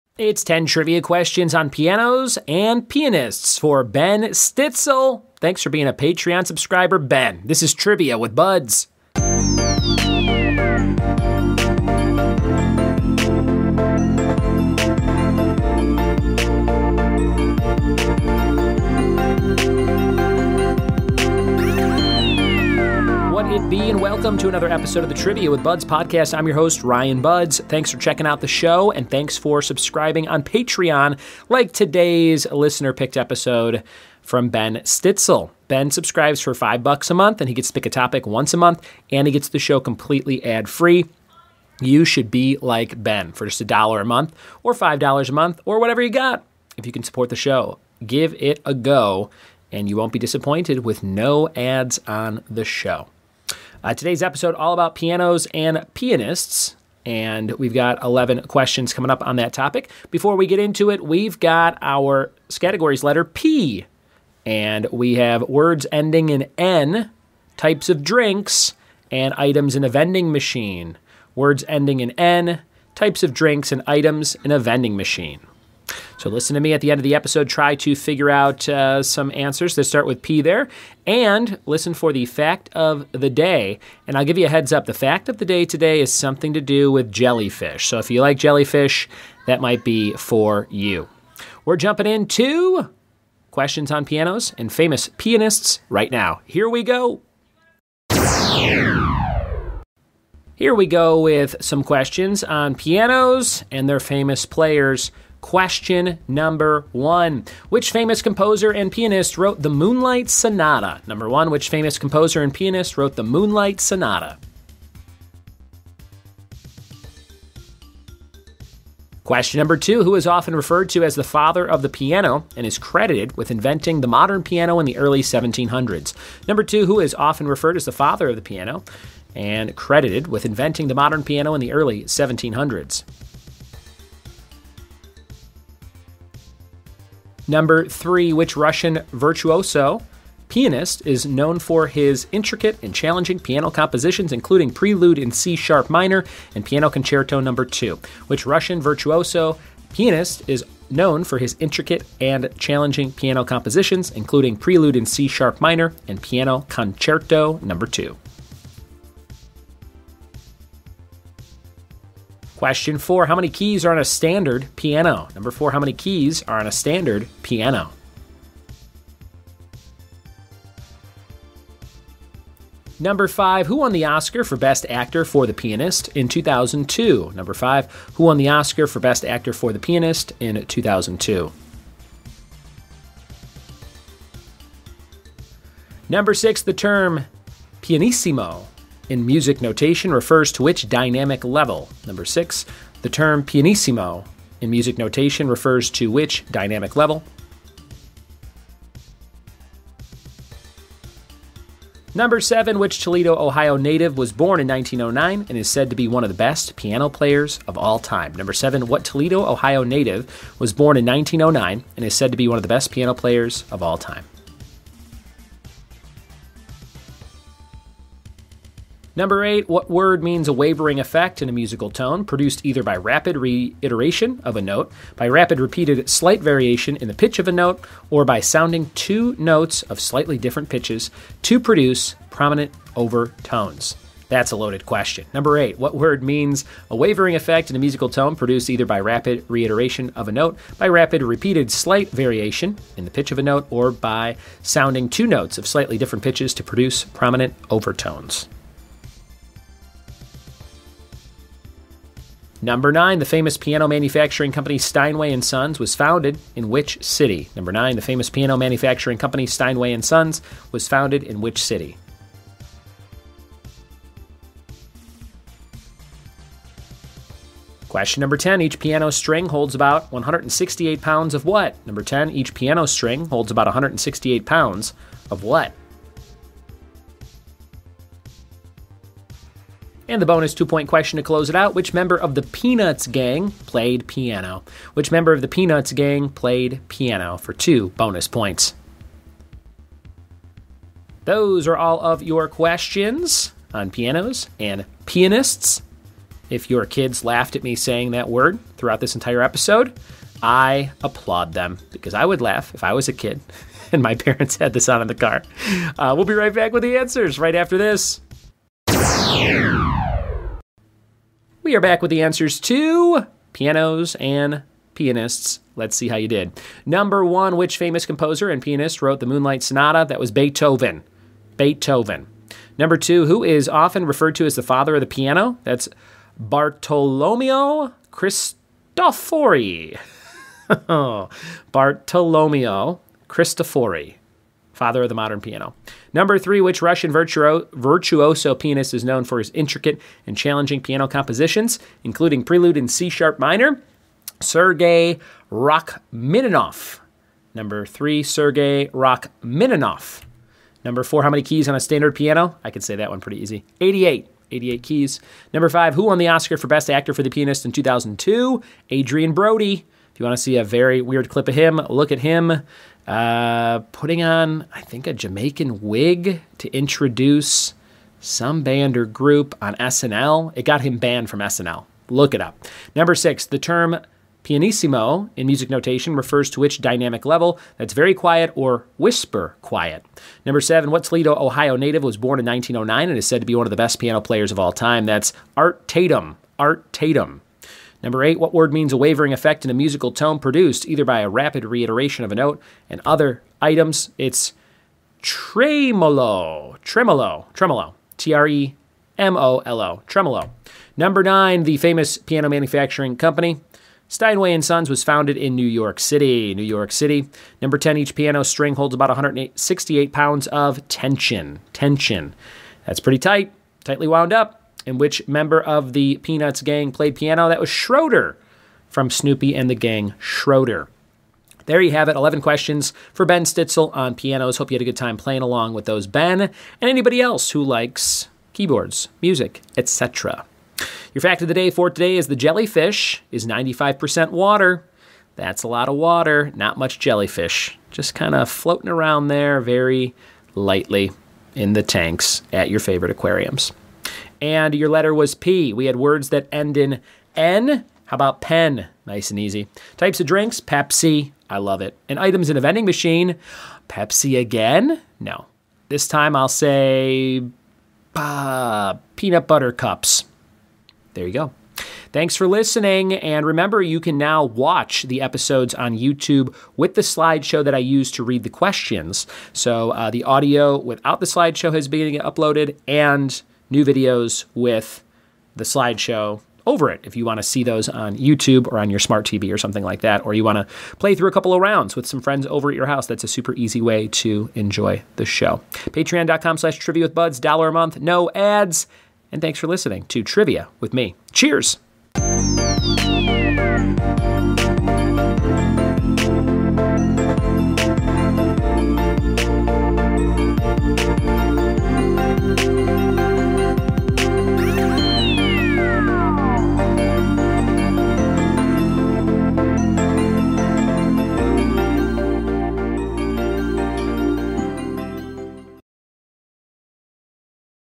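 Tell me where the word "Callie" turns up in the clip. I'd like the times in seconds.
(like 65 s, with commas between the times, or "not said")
not said.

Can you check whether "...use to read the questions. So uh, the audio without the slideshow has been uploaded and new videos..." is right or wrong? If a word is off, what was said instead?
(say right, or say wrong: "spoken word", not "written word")
right.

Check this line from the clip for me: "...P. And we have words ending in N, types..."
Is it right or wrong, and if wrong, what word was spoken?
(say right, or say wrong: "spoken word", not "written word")
right.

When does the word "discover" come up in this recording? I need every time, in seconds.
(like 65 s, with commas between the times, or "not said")
not said.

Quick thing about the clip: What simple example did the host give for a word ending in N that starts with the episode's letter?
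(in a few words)
Pen.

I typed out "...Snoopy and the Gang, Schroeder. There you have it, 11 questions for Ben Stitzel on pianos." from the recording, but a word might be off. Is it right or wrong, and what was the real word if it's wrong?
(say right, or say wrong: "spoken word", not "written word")
right.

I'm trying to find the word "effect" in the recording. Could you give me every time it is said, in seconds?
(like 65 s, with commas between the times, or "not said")
220 s, 237 s, 389 s.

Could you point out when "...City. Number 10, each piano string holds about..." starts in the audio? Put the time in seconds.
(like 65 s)
406 s.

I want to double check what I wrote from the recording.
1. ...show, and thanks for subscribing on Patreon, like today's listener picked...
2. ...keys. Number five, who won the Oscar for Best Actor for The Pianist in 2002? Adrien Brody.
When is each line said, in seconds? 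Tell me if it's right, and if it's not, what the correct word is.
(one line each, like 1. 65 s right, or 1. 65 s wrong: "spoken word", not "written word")
1. 28 s right
2. 354 s right.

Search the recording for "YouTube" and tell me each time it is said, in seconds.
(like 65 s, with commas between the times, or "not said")
465 s, 478 s.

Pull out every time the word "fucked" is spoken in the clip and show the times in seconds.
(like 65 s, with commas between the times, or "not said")
not said.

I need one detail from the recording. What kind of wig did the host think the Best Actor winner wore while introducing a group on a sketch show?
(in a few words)
Jamaican wig.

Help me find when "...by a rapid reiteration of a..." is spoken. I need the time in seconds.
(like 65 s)
391 s.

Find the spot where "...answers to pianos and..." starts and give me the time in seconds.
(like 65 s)
312 s.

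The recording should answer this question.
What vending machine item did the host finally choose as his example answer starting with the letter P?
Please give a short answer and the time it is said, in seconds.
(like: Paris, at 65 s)
Peanut butter cups, at 459 s.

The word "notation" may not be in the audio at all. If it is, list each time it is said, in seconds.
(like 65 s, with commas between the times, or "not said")
189 s, 194 s, 375 s.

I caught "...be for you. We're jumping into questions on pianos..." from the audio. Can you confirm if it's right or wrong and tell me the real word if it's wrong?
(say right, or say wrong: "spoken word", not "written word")
right.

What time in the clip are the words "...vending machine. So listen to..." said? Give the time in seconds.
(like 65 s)
74 s.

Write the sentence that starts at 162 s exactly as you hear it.
Question four How many keys are on a standard piano?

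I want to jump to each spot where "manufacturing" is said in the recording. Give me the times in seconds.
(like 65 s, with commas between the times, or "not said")
253 s, 258 s, 402 s.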